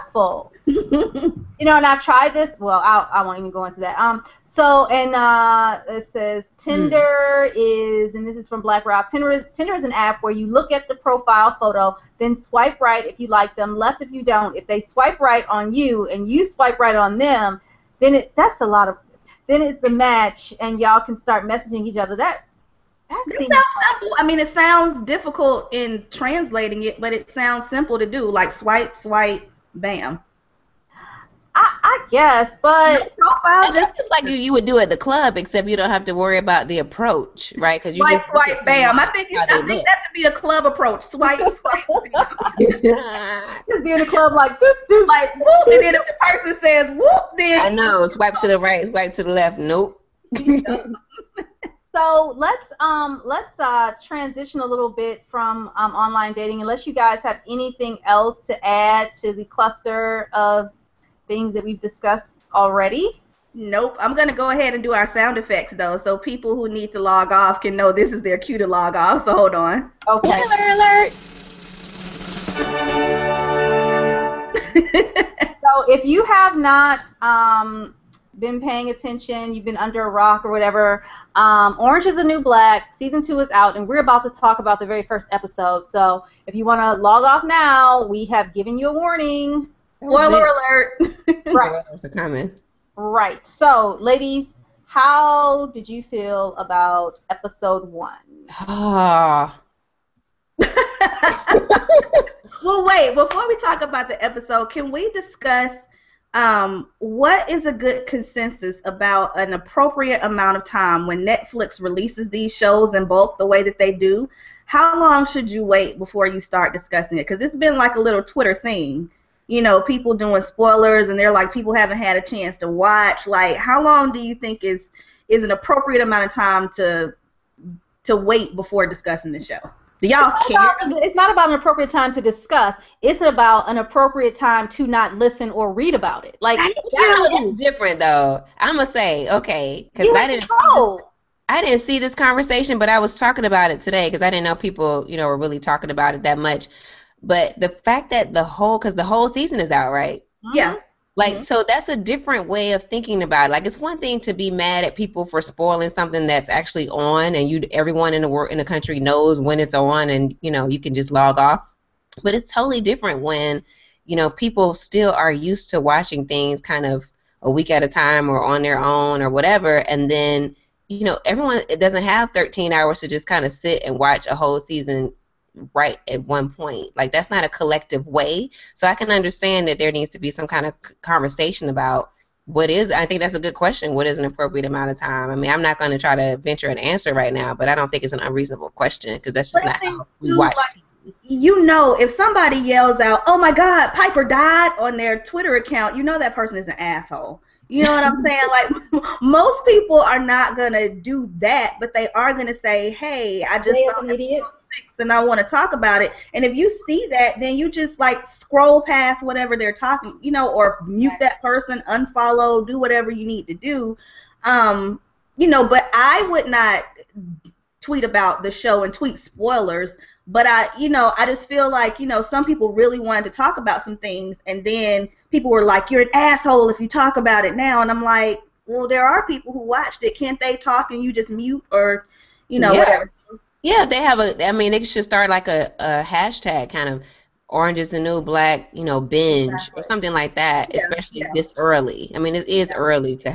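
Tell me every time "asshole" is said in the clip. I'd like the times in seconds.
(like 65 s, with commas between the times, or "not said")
196 s, 226 s.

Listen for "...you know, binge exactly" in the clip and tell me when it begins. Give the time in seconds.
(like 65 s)
238 s.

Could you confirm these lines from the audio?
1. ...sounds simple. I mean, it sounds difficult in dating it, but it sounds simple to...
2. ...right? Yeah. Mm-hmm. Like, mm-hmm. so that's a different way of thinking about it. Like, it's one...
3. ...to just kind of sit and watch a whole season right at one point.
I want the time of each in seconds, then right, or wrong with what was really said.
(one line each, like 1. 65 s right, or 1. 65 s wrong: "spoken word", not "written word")
1. 23 s wrong: "translating", not "dating"
2. 149 s right
3. 172 s right.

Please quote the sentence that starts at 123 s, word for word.
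Like, how long do you think is is an appropriate amount of time to to wait before discussing the show?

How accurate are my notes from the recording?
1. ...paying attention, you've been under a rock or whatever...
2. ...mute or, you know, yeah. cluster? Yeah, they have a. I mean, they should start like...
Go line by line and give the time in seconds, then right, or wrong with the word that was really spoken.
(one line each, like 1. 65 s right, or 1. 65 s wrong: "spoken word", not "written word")
1. 78 s right
2. 231 s wrong: "whatever", not "cluster".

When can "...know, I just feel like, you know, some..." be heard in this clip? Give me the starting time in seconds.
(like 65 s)
220 s.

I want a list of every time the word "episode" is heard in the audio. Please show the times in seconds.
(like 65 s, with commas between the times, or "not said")
85 s, 97 s, 104 s.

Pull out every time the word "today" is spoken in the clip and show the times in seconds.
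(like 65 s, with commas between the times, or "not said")
143 s.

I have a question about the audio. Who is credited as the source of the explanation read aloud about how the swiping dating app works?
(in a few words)
Black Rob.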